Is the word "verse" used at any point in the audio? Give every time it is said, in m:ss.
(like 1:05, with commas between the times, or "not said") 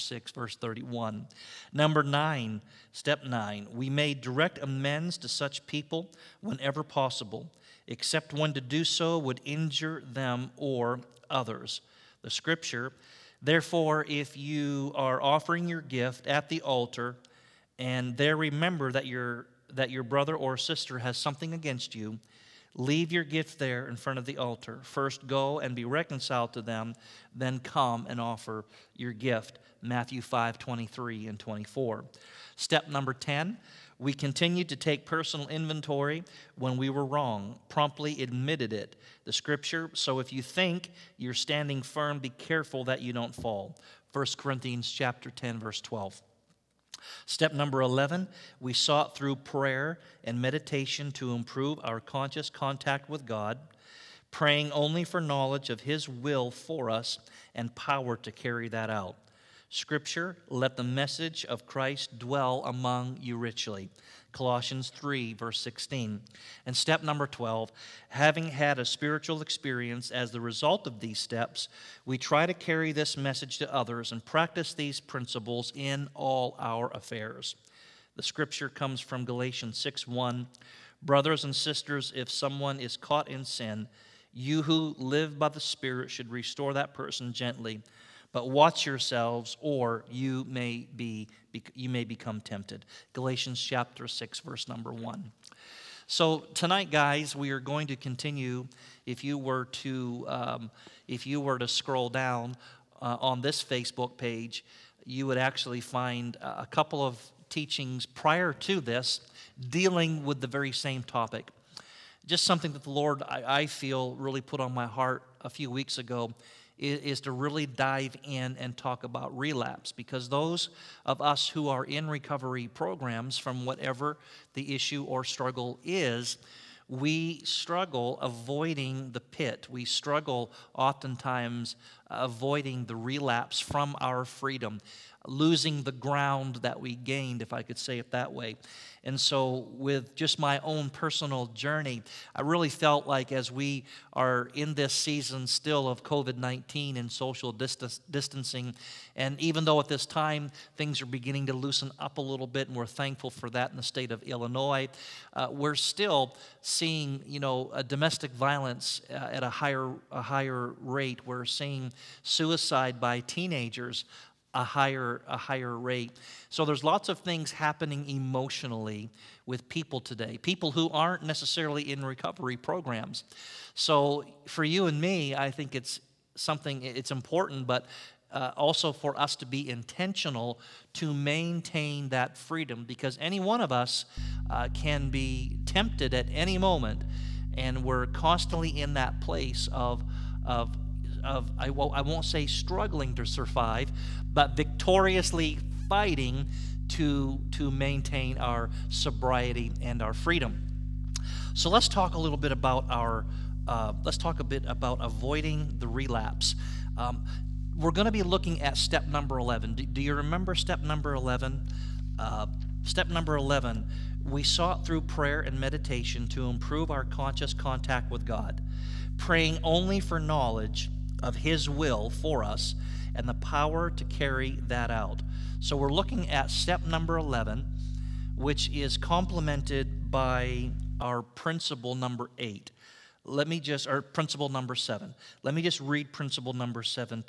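0:00, 0:45, 1:05, 1:34.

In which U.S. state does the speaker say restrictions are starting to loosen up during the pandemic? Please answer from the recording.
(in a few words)
Illinois.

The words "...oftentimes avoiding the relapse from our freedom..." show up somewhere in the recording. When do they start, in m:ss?
2:10.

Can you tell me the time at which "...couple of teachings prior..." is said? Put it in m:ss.
1:46.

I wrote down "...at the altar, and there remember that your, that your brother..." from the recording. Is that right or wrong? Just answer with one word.
right.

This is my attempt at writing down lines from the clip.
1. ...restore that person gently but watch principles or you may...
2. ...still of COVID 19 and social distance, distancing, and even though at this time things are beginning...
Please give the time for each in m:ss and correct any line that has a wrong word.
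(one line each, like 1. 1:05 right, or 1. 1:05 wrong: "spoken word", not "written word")
1. 1:26 wrong: "yourselves", not "principles"
2. 2:25 right.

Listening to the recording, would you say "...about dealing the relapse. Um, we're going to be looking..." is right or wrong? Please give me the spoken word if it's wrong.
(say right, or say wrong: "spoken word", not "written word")
wrong: "avoiding", not "dealing".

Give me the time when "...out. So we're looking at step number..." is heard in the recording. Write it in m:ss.
3:44.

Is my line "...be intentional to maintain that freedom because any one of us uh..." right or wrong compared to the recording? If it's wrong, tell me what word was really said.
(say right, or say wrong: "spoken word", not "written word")
right.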